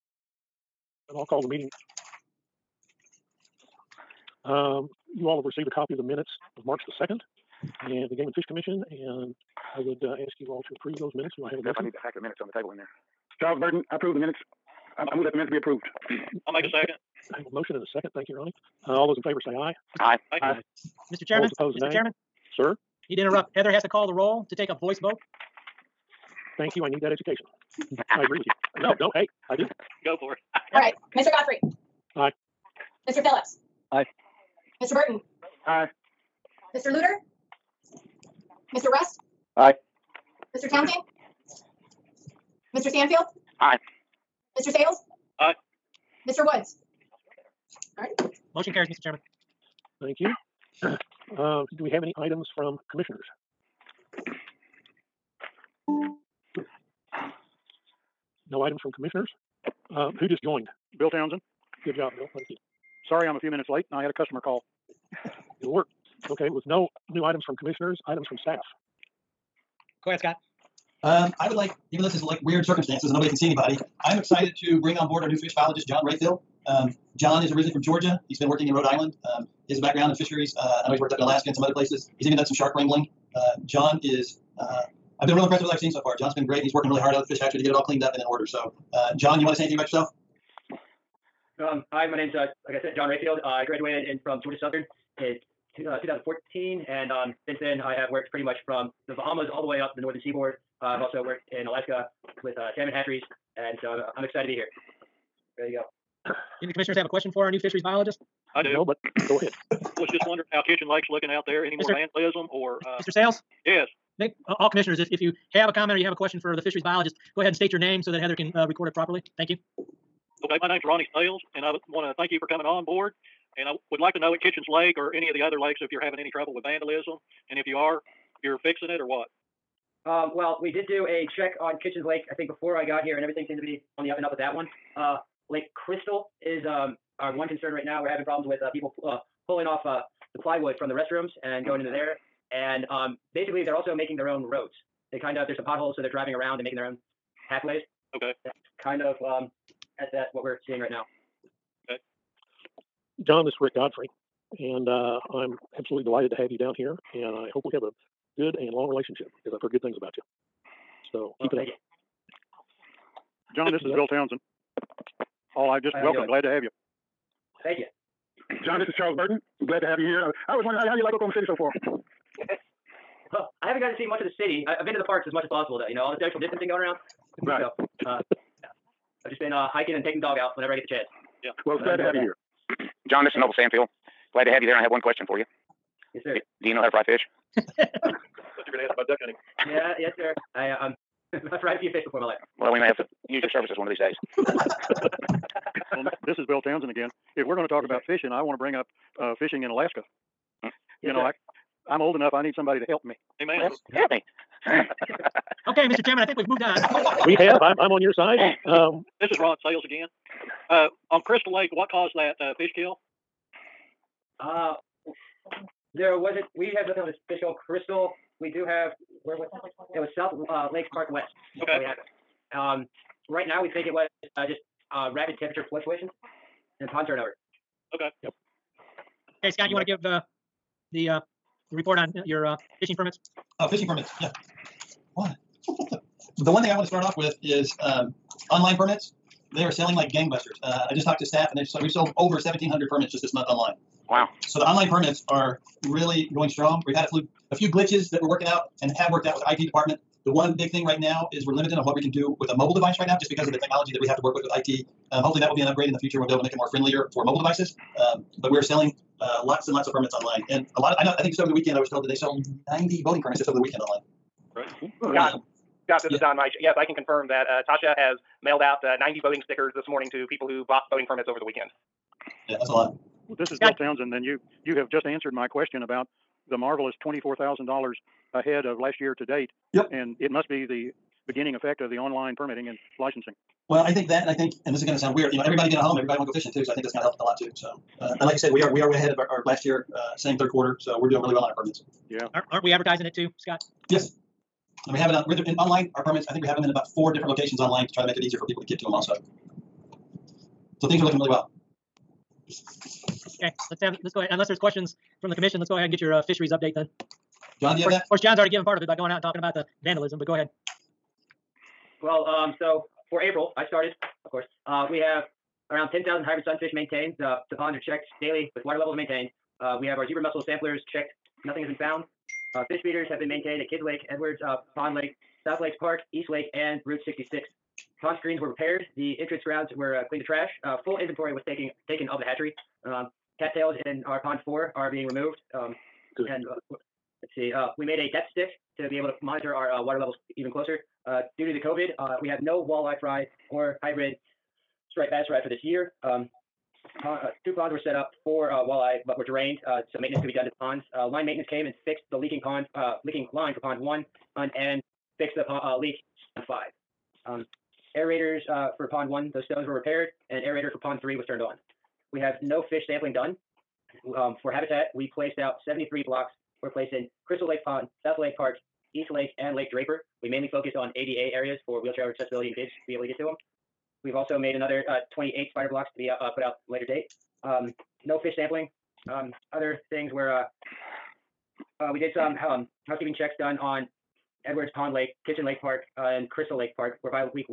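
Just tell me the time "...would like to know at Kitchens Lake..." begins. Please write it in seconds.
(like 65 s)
123 s.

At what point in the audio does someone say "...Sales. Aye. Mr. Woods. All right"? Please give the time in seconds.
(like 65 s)
44 s.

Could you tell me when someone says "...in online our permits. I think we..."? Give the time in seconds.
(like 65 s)
295 s.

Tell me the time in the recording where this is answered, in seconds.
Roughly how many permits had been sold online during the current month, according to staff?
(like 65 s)
242 s.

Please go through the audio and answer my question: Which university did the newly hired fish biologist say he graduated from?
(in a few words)
Georgia Southern.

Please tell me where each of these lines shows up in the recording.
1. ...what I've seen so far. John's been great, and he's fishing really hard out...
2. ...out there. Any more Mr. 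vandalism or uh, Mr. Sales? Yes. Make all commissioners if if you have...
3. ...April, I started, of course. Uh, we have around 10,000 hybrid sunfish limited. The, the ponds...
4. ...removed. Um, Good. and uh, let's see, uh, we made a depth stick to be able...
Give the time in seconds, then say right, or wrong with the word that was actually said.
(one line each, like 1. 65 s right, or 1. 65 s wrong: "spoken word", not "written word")
1. 85 s wrong: "working", not "fishing"
2. 111 s right
3. 313 s wrong: "maintained", not "limited"
4. 335 s right.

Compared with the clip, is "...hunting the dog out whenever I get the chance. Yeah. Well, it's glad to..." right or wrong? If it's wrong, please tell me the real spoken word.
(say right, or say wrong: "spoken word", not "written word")
wrong: "taking", not "hunting".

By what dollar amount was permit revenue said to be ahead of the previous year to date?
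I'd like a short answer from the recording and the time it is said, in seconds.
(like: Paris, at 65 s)
$24,000, at 277 s.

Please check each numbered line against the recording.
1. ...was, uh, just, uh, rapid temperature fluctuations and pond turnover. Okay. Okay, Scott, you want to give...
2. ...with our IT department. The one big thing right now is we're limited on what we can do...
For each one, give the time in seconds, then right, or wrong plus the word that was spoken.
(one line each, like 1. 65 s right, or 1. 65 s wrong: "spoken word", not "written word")
1. 223 s right
2. 249 s right.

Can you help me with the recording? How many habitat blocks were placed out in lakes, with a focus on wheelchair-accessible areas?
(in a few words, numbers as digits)
73.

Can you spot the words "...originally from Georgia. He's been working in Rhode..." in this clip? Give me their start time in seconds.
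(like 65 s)
77 s.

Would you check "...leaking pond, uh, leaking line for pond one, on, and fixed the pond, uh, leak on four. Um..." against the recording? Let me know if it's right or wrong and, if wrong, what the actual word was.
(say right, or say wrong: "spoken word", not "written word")
wrong: "five", not "four".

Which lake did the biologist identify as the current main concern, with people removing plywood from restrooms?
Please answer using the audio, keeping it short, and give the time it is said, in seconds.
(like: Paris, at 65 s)
Lake Crystal, at 135 s.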